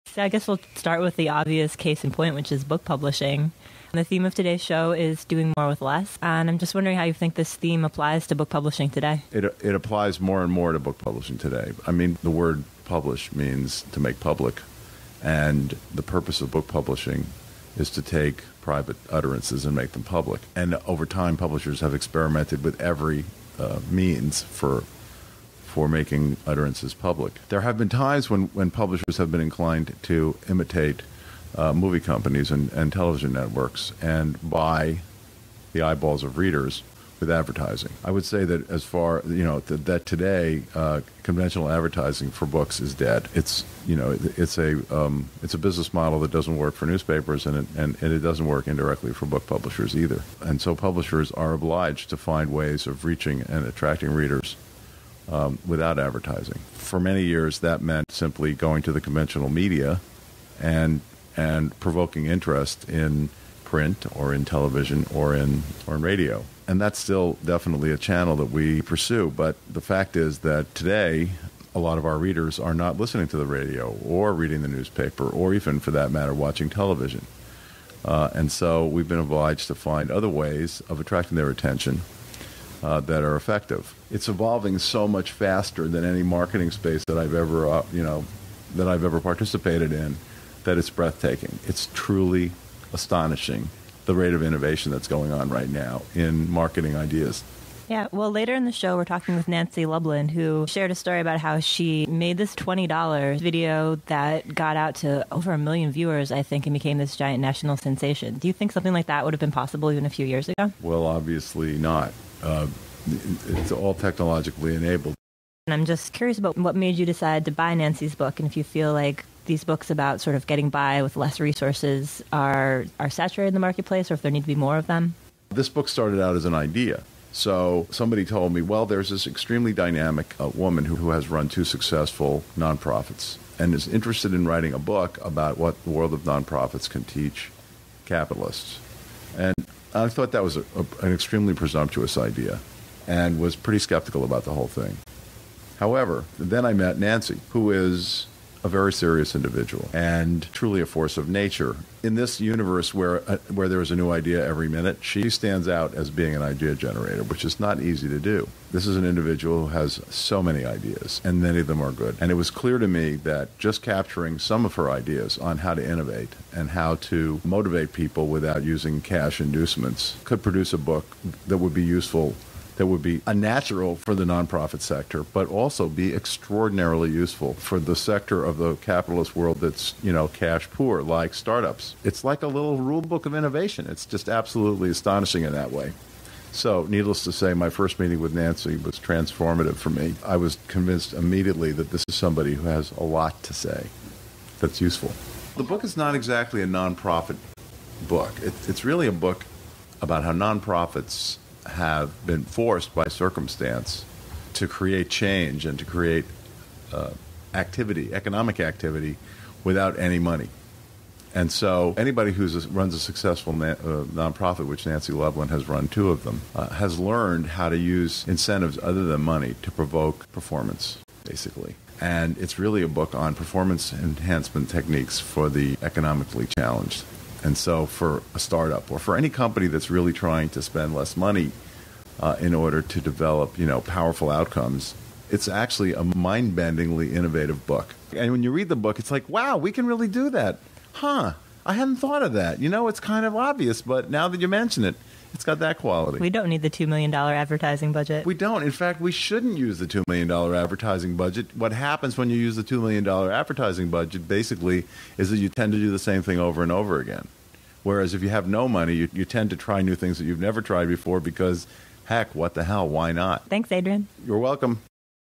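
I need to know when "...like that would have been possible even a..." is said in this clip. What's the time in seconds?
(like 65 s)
108 s.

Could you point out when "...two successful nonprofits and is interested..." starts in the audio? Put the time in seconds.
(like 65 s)
131 s.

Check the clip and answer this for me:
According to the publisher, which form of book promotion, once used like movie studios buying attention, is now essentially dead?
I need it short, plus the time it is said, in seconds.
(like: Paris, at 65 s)
Conventional advertising, at 41 s.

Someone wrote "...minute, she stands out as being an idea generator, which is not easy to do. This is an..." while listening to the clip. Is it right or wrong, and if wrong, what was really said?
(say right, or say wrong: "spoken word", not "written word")
right.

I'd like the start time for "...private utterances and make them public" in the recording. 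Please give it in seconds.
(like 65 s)
18 s.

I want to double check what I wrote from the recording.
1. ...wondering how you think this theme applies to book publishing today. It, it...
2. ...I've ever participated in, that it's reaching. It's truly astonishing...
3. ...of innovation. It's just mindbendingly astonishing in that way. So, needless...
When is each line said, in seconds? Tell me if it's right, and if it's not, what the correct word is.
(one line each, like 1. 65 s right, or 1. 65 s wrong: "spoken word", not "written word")
1. 6 s right
2. 88 s wrong: "breathtaking", not "reaching"
3. 183 s wrong: "absolutely", not "mindbendingly".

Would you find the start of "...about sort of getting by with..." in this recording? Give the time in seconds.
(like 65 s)
119 s.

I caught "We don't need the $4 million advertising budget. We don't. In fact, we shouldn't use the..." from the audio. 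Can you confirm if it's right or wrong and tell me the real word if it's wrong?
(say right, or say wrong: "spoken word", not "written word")
wrong: "2", not "4".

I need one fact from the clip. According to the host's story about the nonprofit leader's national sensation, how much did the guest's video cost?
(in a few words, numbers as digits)
$20.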